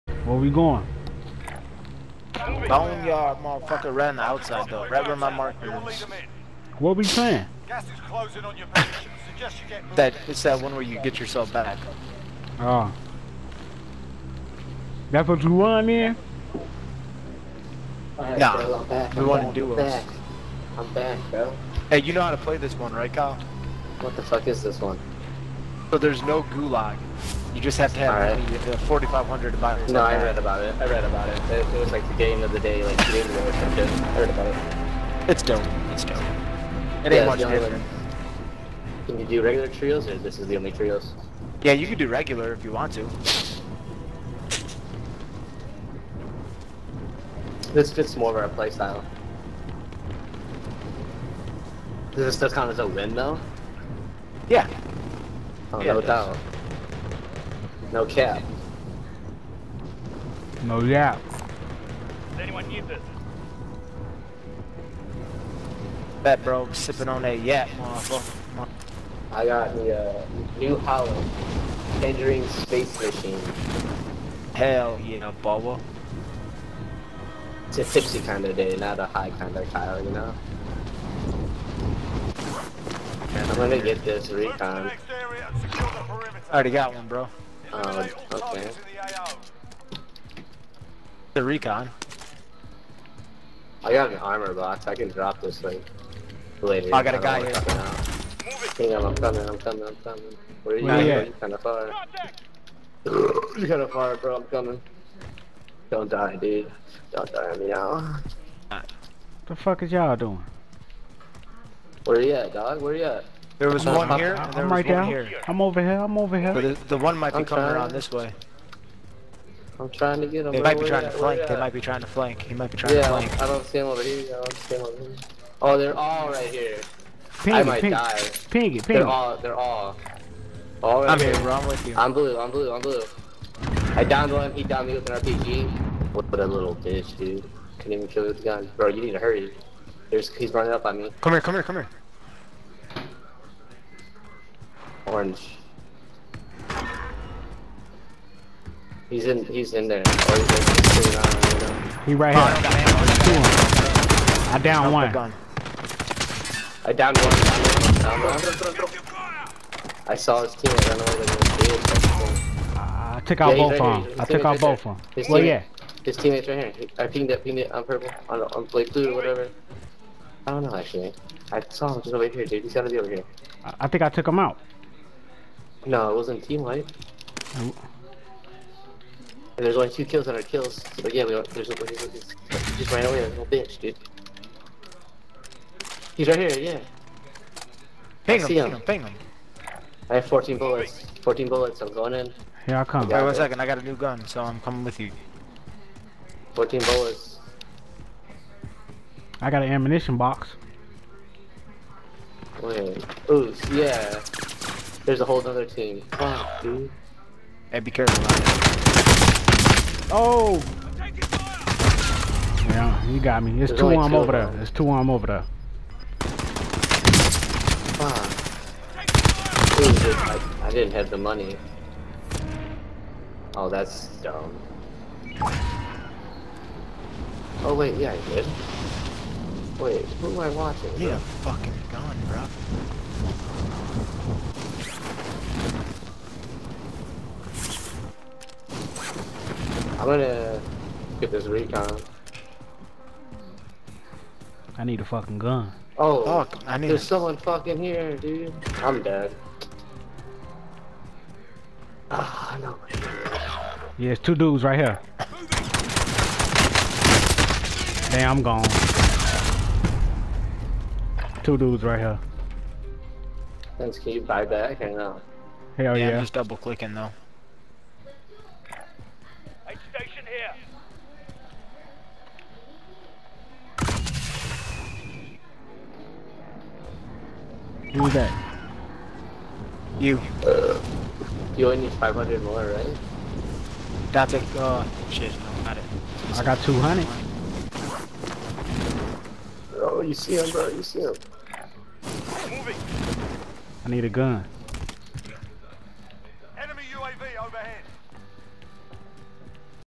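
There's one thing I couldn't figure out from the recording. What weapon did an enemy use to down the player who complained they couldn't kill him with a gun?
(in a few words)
RPG.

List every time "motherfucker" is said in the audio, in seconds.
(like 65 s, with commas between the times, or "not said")
3 s, 67 s.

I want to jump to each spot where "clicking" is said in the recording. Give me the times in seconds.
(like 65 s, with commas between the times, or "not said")
266 s.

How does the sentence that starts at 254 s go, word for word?
Yeah, it's two dudes right here.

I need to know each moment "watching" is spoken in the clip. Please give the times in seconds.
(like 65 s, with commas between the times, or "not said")
230 s.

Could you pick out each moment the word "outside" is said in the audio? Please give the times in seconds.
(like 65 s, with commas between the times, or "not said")
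4 s.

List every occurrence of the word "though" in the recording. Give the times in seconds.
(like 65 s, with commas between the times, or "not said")
4 s, 53 s, 266 s.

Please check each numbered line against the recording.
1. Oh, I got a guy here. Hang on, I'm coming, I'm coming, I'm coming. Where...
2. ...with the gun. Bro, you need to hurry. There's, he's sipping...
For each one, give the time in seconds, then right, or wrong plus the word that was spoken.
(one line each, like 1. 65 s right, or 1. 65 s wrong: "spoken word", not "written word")
1. 96 s right
2. 138 s wrong: "running", not "sipping".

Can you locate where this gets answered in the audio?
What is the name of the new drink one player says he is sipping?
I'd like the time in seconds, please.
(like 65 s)
70 s.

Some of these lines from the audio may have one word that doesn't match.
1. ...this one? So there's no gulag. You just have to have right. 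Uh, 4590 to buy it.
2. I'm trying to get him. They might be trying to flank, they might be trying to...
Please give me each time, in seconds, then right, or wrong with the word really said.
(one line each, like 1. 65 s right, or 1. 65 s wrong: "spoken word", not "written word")
1. 24 s wrong: "4500", not "4590"
2. 119 s right.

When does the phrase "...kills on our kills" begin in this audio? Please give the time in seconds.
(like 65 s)
180 s.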